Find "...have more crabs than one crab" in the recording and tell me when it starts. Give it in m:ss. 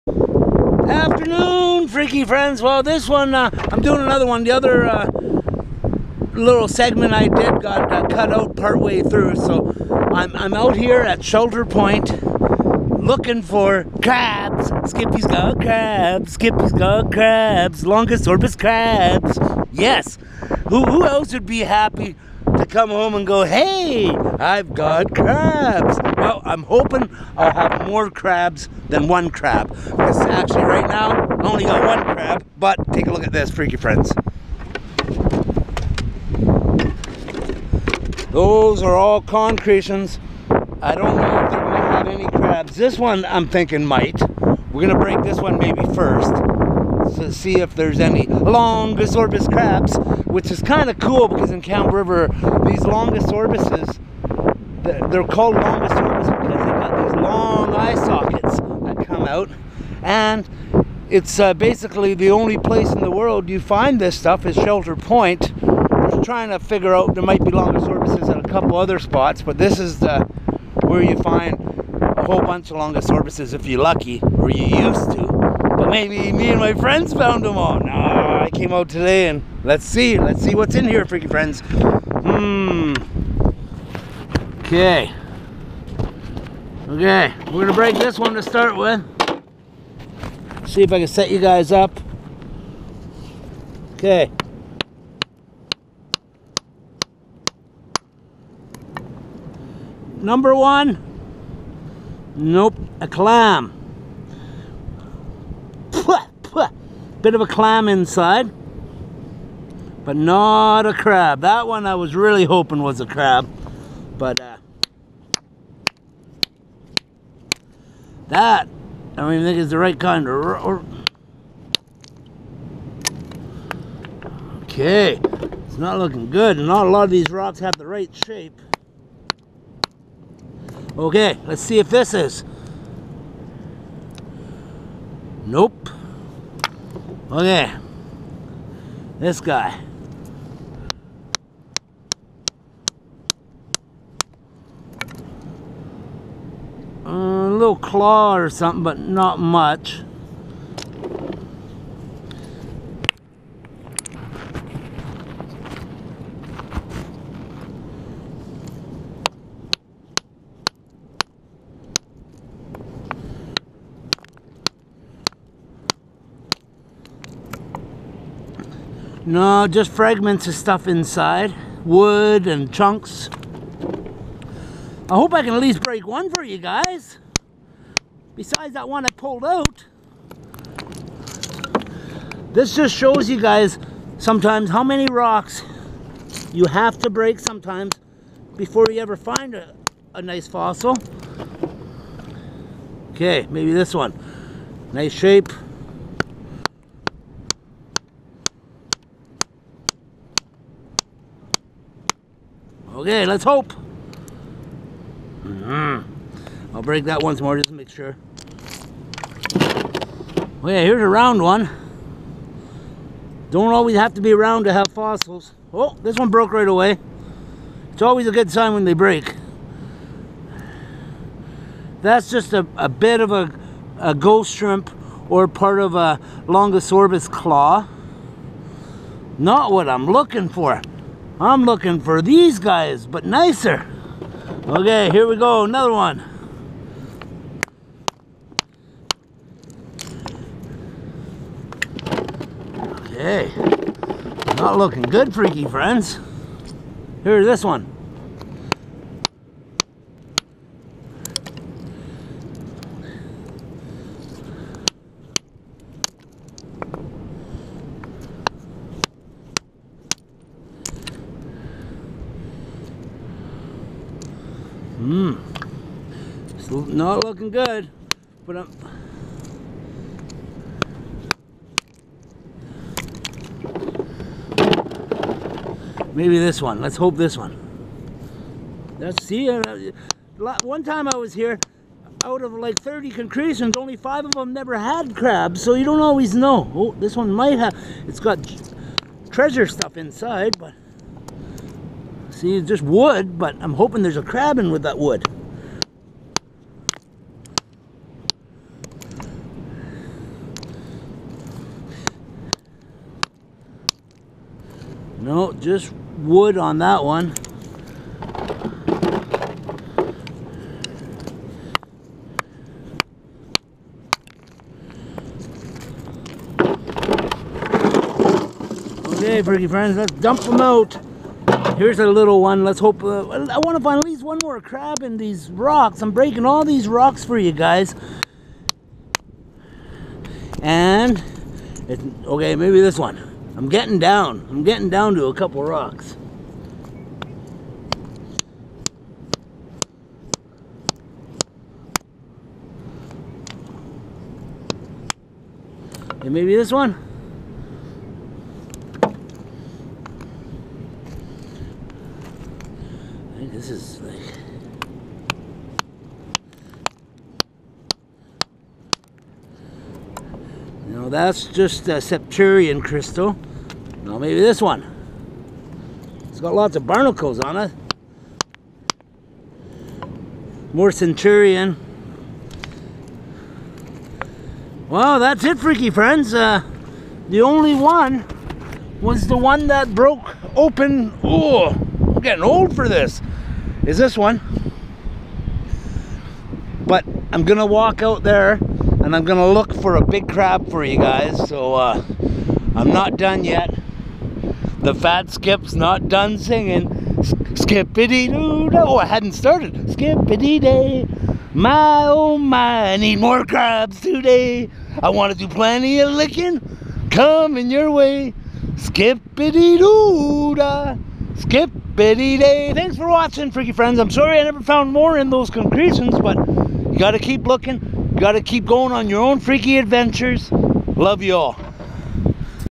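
0:27.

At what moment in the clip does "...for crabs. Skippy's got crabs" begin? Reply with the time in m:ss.
0:13.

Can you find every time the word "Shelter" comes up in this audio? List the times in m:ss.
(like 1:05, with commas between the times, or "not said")
0:11, 1:04.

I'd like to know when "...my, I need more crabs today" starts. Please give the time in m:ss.
6:42.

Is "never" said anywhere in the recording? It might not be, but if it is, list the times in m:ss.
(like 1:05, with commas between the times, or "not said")
4:44, 6:54.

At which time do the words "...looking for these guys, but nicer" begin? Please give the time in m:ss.
3:51.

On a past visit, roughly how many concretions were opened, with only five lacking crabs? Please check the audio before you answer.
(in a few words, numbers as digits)
30.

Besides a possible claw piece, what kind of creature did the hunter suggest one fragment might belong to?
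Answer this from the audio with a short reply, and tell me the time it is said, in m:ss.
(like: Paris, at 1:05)
Ghost shrimp, at 3:44.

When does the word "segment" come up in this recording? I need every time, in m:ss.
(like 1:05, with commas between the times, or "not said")
0:06.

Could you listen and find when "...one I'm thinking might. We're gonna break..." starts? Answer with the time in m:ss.
0:42.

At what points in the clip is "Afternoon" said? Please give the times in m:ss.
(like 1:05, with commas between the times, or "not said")
0:00.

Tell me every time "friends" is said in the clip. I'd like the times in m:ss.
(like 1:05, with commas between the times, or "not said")
0:02, 0:33, 1:16, 1:21, 4:05, 5:19, 6:15, 6:53.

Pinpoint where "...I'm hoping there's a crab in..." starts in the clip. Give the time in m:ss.
4:53.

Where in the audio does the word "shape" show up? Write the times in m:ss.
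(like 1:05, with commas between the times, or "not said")
2:08, 3:15.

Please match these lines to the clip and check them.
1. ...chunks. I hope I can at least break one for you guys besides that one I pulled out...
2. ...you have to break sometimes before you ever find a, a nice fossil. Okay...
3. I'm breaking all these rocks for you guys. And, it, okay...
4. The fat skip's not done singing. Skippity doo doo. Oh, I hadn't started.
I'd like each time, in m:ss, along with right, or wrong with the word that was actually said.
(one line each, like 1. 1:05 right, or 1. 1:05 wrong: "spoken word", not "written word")
1. 2:52 right
2. 3:06 right
3. 5:26 right
4. 6:34 right.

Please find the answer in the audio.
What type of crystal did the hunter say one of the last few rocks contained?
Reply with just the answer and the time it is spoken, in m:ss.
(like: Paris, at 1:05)
Septarian crystal, at 6:01.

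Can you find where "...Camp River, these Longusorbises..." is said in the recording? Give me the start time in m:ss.
0:51.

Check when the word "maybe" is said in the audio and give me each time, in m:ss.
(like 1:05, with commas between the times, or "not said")
0:45, 1:15, 3:13, 4:36, 5:32, 5:46, 6:04.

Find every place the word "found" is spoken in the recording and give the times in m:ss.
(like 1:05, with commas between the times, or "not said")
1:17, 6:54.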